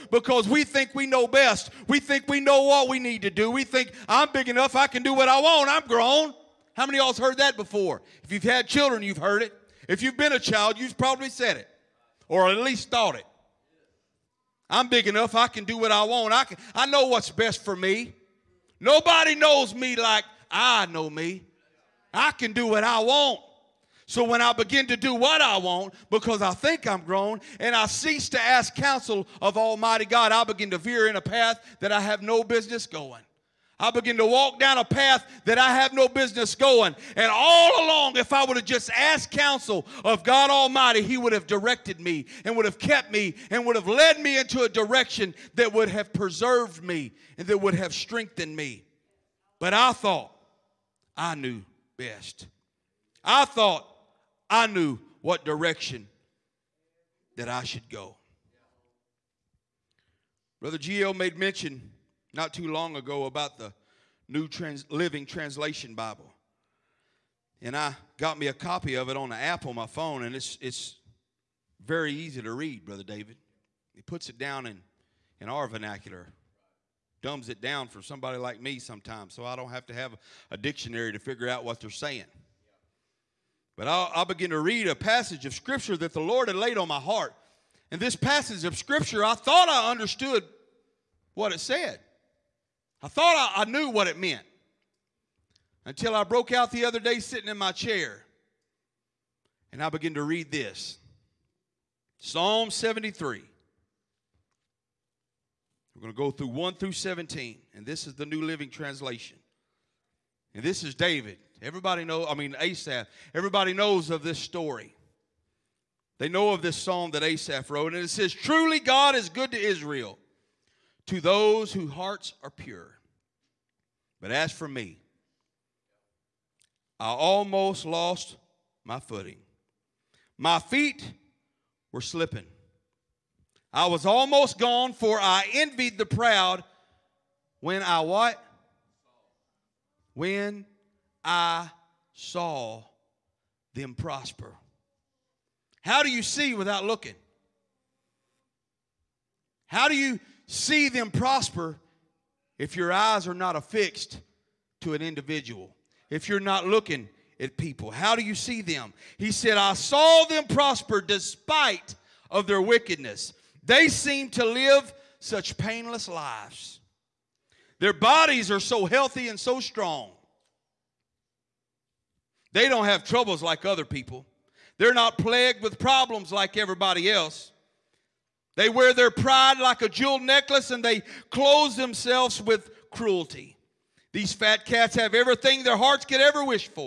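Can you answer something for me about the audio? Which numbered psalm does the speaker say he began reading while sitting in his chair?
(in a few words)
Psalm 73.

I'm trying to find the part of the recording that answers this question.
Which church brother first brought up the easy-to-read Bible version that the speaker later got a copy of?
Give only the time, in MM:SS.
01:00.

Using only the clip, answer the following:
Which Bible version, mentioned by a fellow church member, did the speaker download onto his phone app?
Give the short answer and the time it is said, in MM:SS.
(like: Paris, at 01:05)
New Living Translation, at 01:48.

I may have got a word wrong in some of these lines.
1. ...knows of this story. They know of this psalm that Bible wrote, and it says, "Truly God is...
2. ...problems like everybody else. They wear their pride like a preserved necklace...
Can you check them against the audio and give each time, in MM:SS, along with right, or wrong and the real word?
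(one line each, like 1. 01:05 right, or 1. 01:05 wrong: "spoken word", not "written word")
1. 01:53 wrong: "Asaph", not "Bible"
2. 02:55 wrong: "jeweled", not "preserved".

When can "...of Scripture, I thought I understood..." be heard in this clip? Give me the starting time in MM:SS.
01:28.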